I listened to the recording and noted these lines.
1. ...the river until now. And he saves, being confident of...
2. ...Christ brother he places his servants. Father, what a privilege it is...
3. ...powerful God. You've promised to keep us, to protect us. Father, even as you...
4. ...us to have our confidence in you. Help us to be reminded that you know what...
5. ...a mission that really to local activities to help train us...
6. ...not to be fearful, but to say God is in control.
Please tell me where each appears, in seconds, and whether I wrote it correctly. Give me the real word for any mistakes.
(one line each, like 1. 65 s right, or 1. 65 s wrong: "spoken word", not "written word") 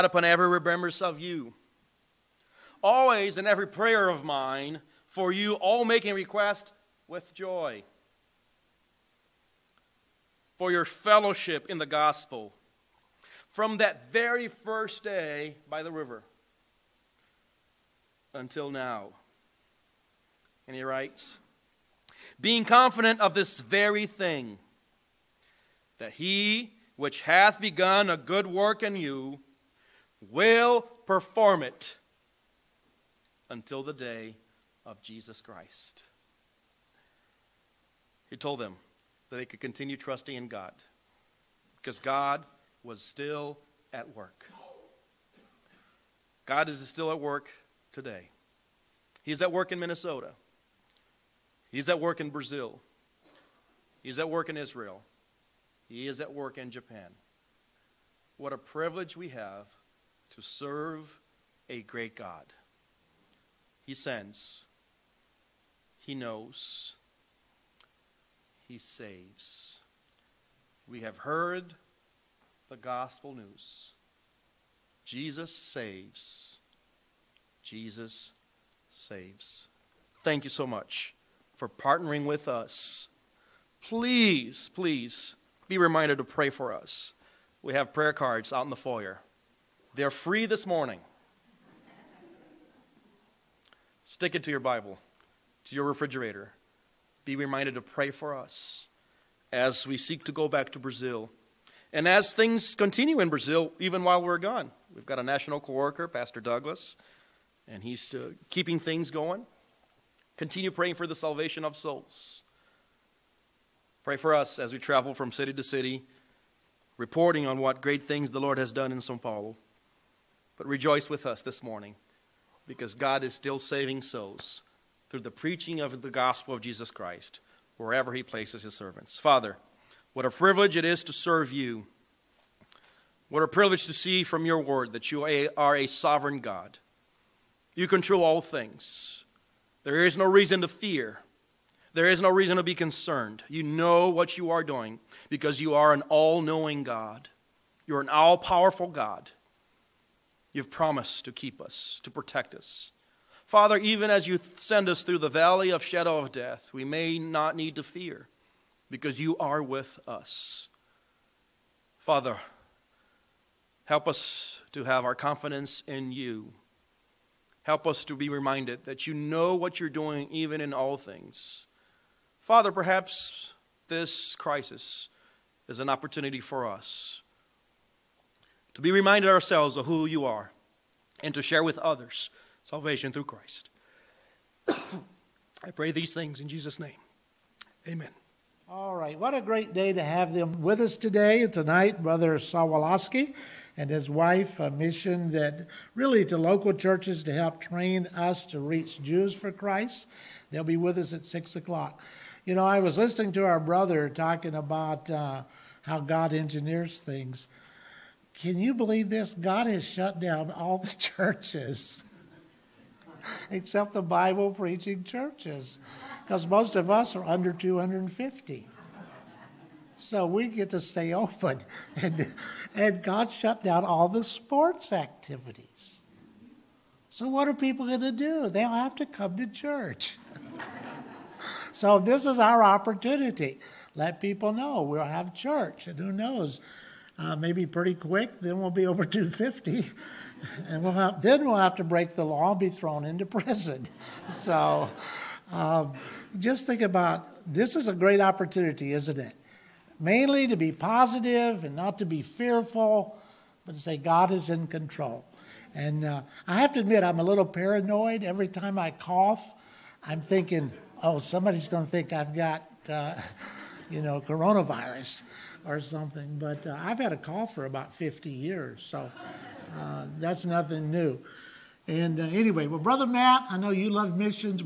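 1. 15 s wrong: "writes", not "saves"
2. 126 s wrong: "wherever", not "brother"
3. 148 s right
4. 164 s right
5. 194 s wrong: "churches", not "activities"
6. 251 s right.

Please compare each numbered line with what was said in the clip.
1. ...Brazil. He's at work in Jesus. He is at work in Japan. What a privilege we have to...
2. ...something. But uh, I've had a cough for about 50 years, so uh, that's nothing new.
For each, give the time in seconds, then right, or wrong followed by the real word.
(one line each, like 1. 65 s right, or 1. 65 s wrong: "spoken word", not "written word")
1. 52 s wrong: "Israel", not "Jesus"
2. 265 s right.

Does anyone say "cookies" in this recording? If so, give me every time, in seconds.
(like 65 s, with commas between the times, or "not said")
not said.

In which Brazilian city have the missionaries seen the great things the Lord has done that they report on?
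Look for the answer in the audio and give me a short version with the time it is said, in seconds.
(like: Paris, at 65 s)
Sao Paulo, at 118 s.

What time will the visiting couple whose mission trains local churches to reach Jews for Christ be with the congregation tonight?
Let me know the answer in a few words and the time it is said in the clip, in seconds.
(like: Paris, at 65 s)
6 o'clock, at 201 s.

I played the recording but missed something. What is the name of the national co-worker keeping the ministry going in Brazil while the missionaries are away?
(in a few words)
Pastor Douglas.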